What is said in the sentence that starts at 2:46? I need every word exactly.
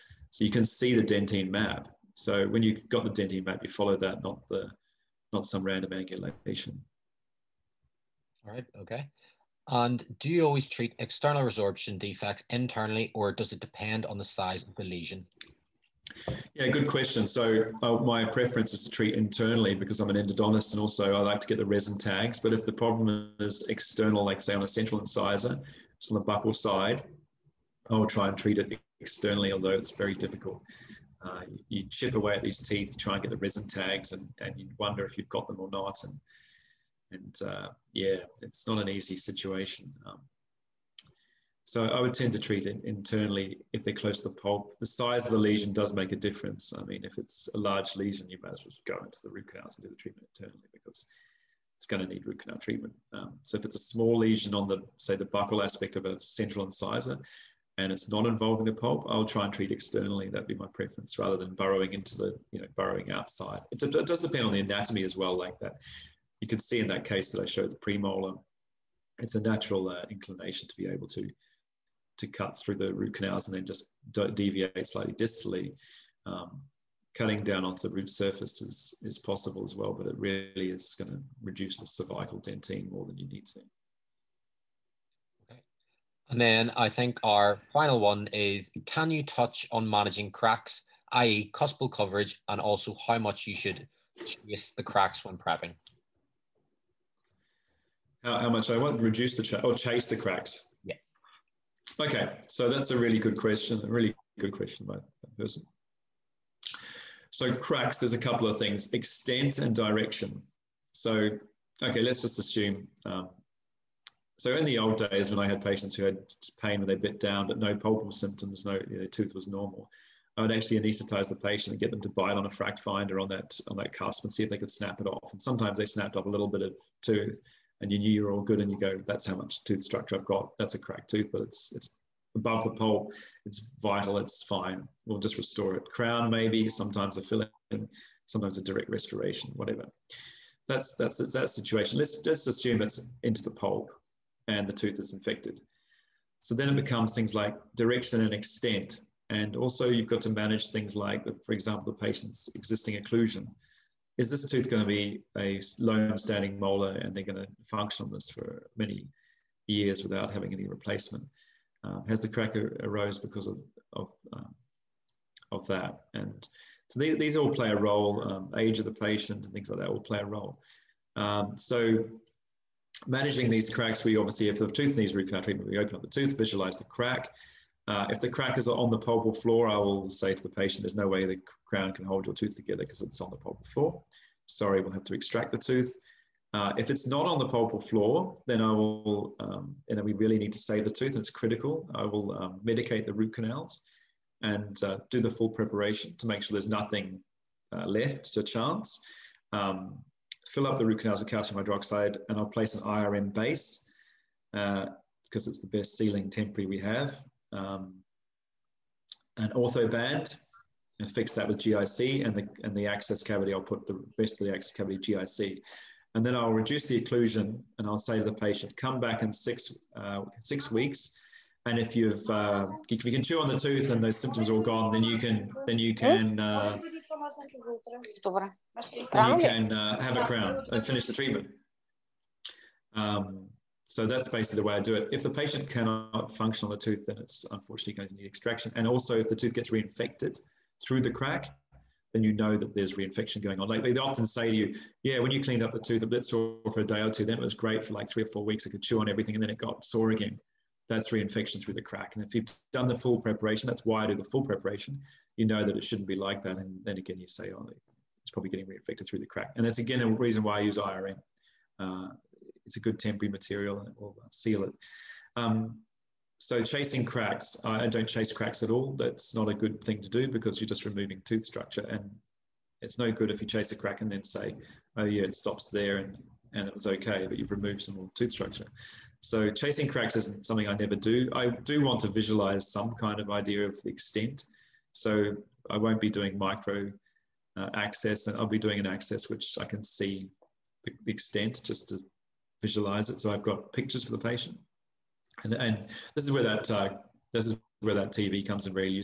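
And so these, these all play a role.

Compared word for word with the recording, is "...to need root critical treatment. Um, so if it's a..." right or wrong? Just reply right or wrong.
wrong.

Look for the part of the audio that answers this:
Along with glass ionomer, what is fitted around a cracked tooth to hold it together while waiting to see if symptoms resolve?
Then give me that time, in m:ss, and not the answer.
3:29.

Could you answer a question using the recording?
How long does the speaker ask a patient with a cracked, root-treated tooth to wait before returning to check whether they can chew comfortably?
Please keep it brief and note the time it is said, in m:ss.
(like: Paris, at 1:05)
6 weeks, at 3:40.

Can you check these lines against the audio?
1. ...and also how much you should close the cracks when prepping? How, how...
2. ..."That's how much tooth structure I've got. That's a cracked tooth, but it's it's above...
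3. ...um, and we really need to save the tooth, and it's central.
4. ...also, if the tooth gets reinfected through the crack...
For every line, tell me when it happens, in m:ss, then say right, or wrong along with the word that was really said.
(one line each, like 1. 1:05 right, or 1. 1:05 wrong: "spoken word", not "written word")
1. 1:32 wrong: "chase", not "close"
2. 2:09 right
3. 3:09 wrong: "critical", not "central"
4. 3:58 right.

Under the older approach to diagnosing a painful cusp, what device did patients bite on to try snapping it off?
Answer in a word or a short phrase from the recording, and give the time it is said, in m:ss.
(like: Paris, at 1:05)
FracFinder, at 2:02.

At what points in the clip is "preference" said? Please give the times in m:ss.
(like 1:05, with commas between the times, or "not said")
0:18, 1:00.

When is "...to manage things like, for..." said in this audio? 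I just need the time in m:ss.
2:30.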